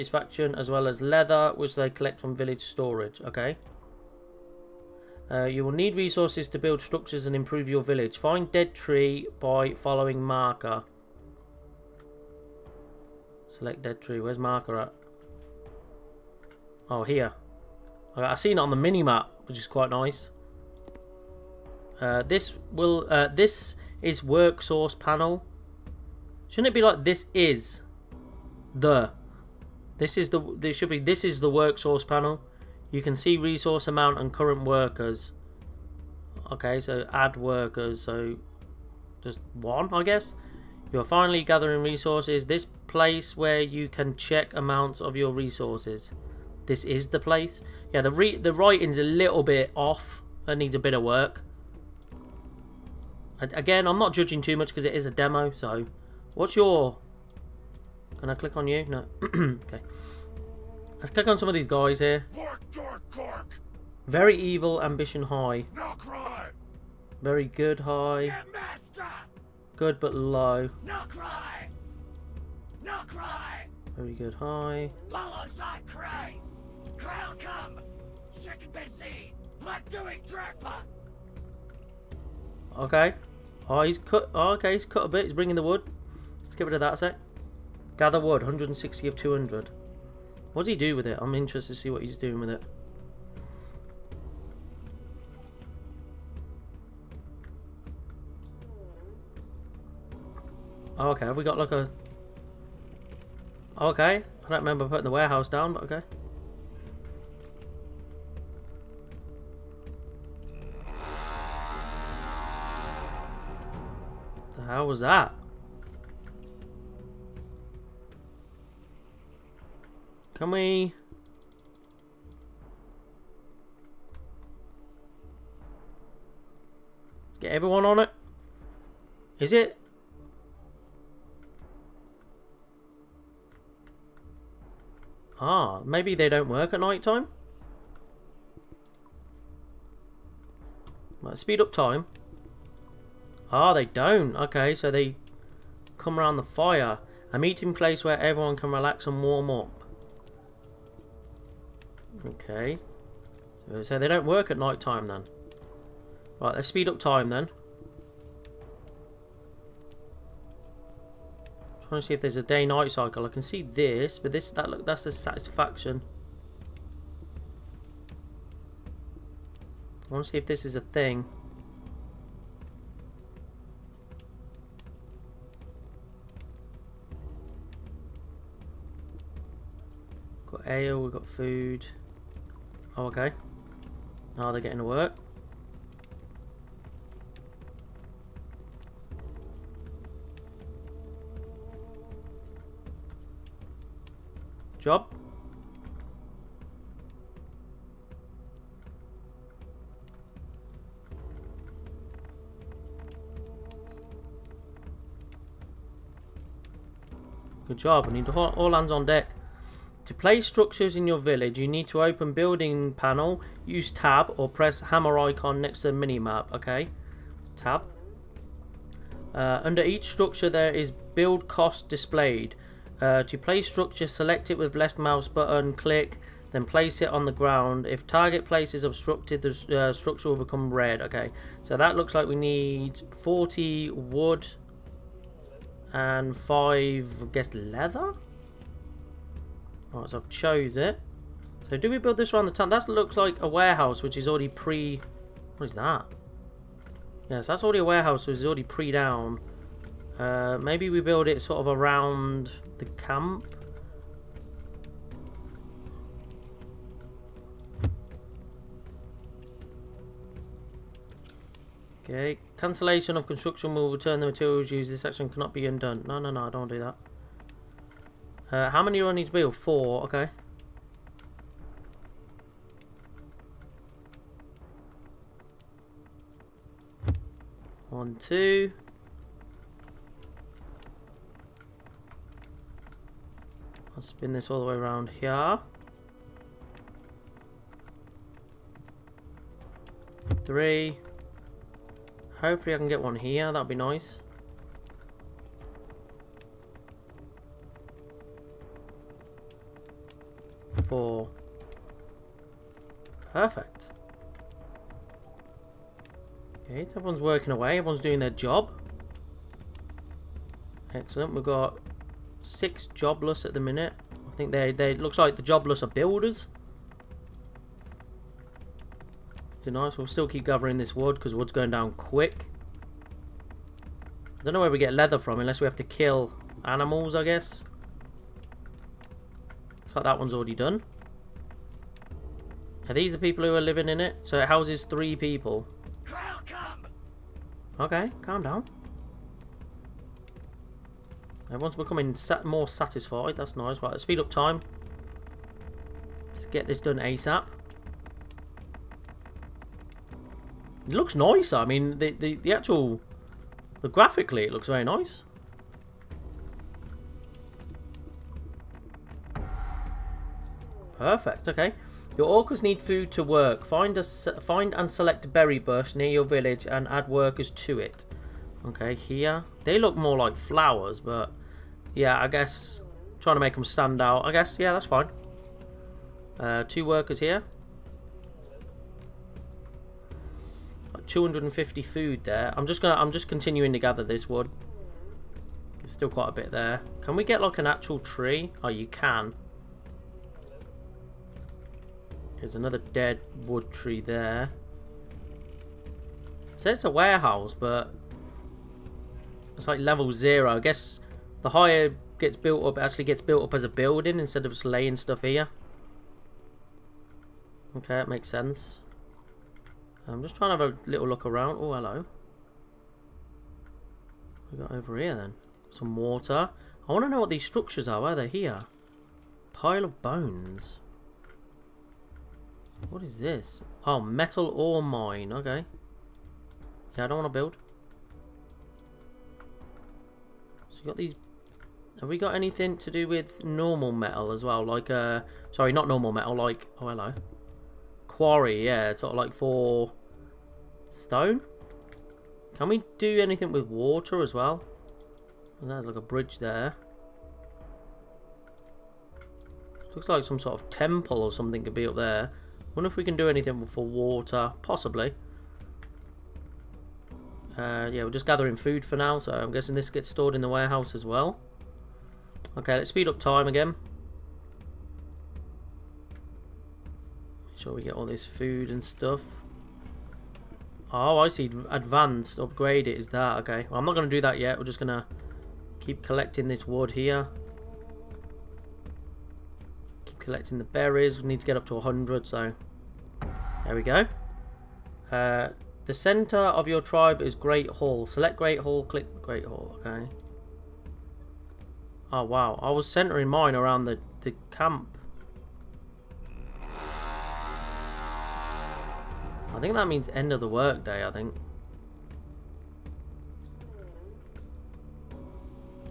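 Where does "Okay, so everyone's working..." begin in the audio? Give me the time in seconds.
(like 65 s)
306 s.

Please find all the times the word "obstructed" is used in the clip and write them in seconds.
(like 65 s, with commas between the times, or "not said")
228 s.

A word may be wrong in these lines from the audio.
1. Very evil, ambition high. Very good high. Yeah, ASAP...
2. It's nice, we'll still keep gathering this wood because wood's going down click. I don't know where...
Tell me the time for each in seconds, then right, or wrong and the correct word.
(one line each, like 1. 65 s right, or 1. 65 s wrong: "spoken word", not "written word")
1. 64 s wrong: "Good", not "ASAP"
2. 319 s wrong: "quick", not "click".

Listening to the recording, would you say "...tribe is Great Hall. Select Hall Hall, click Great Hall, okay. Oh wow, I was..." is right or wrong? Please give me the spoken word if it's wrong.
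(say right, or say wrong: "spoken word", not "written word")
wrong: "Great", not "Hall".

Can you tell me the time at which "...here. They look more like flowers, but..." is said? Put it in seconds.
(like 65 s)
368 s.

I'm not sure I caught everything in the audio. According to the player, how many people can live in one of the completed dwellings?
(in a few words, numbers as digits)
3.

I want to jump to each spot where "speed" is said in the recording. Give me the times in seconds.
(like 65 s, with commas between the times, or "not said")
141 s, 156 s, 344 s, 462 s.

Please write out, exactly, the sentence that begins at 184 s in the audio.
Now oh, they're getting to work.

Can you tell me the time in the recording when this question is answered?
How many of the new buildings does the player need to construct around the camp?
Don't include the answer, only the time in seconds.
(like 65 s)
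269 s.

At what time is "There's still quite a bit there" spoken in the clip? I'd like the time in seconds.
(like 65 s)
385 s.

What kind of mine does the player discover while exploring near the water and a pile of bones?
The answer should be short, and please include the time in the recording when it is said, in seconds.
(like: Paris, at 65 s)
metal ore mine, at 423 s.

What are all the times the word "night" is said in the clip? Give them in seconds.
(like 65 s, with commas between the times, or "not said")
136 s, 154 s, 162 s.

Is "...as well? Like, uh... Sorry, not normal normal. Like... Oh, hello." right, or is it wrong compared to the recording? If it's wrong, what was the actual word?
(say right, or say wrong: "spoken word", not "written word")
wrong: "metal", not "normal".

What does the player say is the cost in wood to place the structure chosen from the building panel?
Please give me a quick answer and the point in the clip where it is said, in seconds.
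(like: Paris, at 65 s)
40, at 233 s.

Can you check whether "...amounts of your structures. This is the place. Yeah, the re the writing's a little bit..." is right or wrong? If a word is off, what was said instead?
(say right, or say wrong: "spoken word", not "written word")
wrong: "resources", not "structures".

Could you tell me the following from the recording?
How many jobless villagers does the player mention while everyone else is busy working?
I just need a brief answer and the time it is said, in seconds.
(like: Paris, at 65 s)
6, at 312 s.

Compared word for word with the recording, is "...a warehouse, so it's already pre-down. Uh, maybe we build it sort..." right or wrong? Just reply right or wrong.
right.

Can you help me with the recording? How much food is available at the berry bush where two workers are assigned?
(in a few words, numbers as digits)
250.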